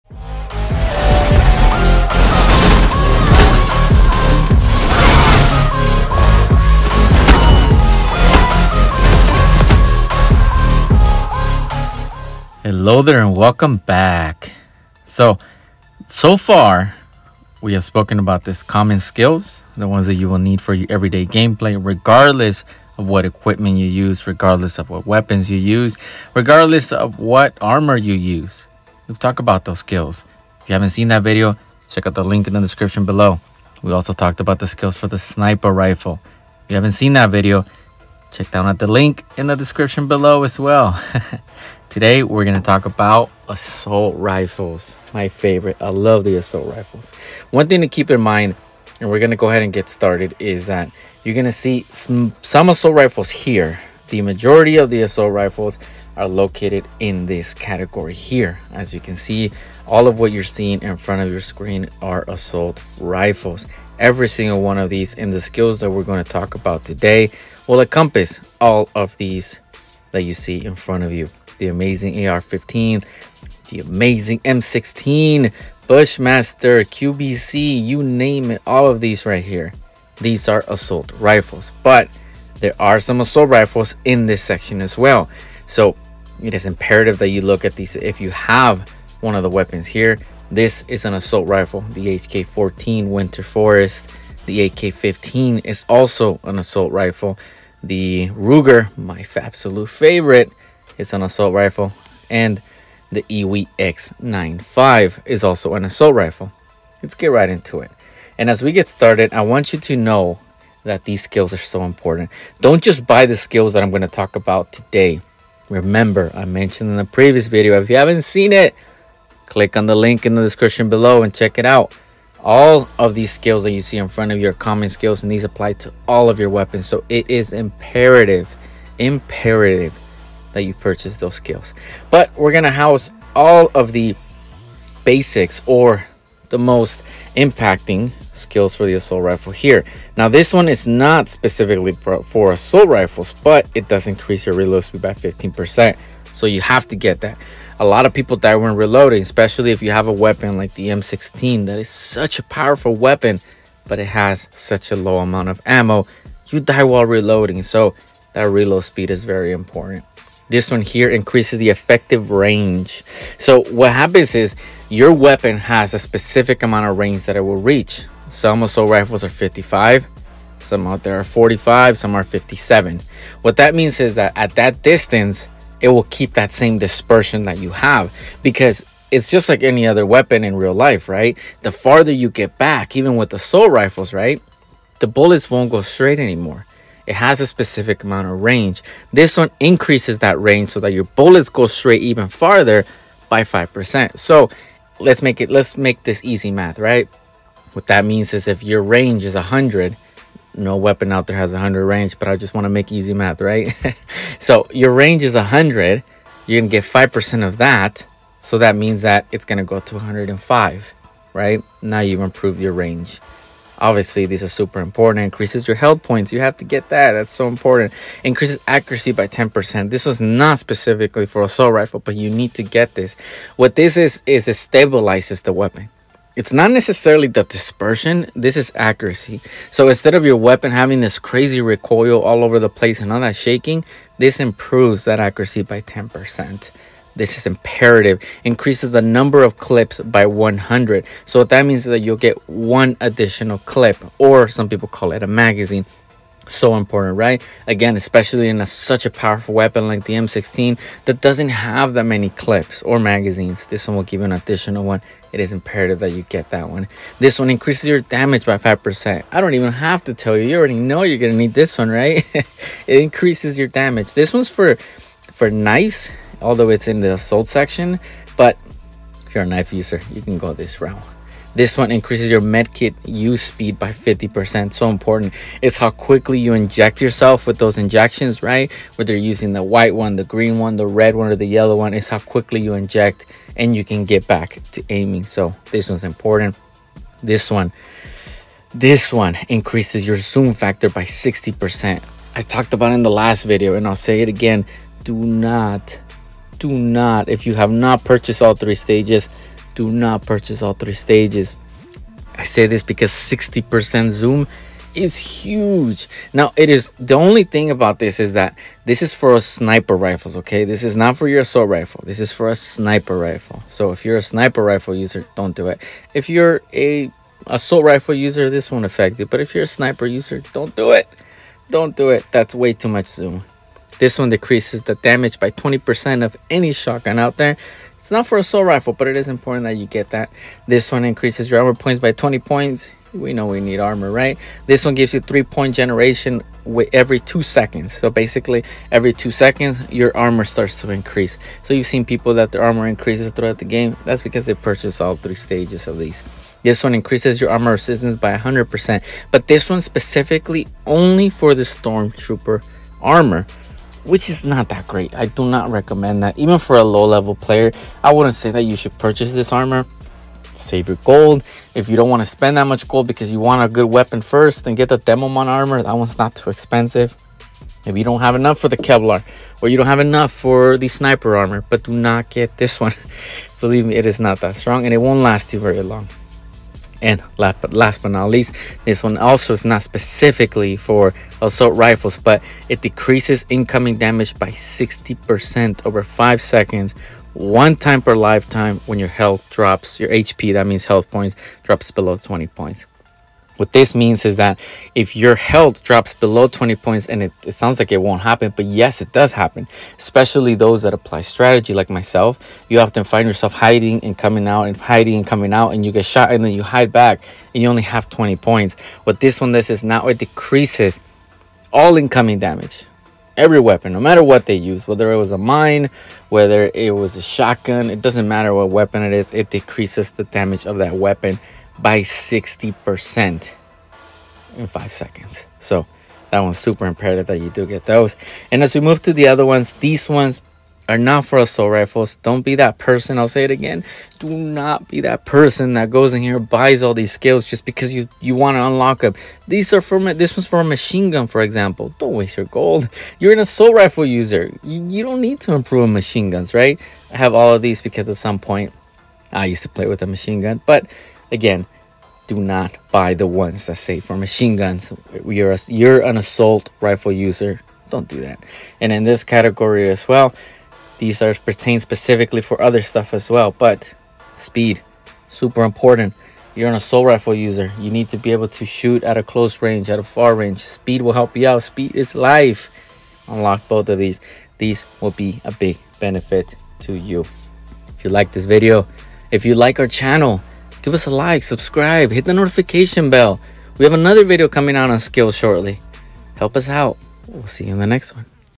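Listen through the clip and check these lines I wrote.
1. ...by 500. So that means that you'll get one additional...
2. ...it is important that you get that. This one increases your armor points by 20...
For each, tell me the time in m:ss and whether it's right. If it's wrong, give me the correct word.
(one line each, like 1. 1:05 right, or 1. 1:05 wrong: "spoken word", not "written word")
1. 3:59 wrong: "100", not "500"
2. 5:29 right.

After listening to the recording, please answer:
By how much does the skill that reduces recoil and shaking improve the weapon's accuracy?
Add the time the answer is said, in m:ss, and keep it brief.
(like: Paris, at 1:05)
10%, at 3:55.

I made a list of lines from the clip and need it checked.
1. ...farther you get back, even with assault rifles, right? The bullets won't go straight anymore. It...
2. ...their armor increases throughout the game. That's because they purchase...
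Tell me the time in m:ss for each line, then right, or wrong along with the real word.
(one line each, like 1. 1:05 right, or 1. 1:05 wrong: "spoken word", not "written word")
1. 3:01 right
2. 5:42 right.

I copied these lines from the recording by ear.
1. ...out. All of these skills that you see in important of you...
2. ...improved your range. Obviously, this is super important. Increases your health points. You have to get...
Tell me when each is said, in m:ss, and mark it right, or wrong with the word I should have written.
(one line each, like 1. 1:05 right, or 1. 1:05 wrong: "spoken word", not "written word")
1. 2:01 wrong: "front", not "important"
2. 3:32 right.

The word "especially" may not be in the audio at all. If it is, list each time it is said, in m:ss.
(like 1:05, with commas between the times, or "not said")
2:29, 4:07, 6:39.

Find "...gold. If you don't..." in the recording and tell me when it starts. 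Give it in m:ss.
6:01.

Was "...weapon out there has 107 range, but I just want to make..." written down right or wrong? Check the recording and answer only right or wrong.
wrong.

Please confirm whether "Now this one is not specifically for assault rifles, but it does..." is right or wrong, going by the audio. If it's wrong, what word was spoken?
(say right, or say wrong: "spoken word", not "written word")
right.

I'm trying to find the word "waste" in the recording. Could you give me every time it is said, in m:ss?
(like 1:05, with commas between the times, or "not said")
7:22.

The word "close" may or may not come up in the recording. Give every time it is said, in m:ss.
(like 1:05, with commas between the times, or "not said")
7:49.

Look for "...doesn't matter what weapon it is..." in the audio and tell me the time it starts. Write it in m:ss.
6:58.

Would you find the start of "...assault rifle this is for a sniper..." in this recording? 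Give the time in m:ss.
5:11.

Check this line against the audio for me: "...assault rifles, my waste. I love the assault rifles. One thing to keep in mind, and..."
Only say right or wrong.
wrong.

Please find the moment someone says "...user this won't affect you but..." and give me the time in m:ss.
5:18.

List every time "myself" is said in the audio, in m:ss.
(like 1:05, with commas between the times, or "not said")
6:41.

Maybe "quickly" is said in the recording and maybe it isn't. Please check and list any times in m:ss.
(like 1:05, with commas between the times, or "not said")
4:35, 4:42.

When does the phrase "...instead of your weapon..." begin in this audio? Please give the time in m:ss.
3:49.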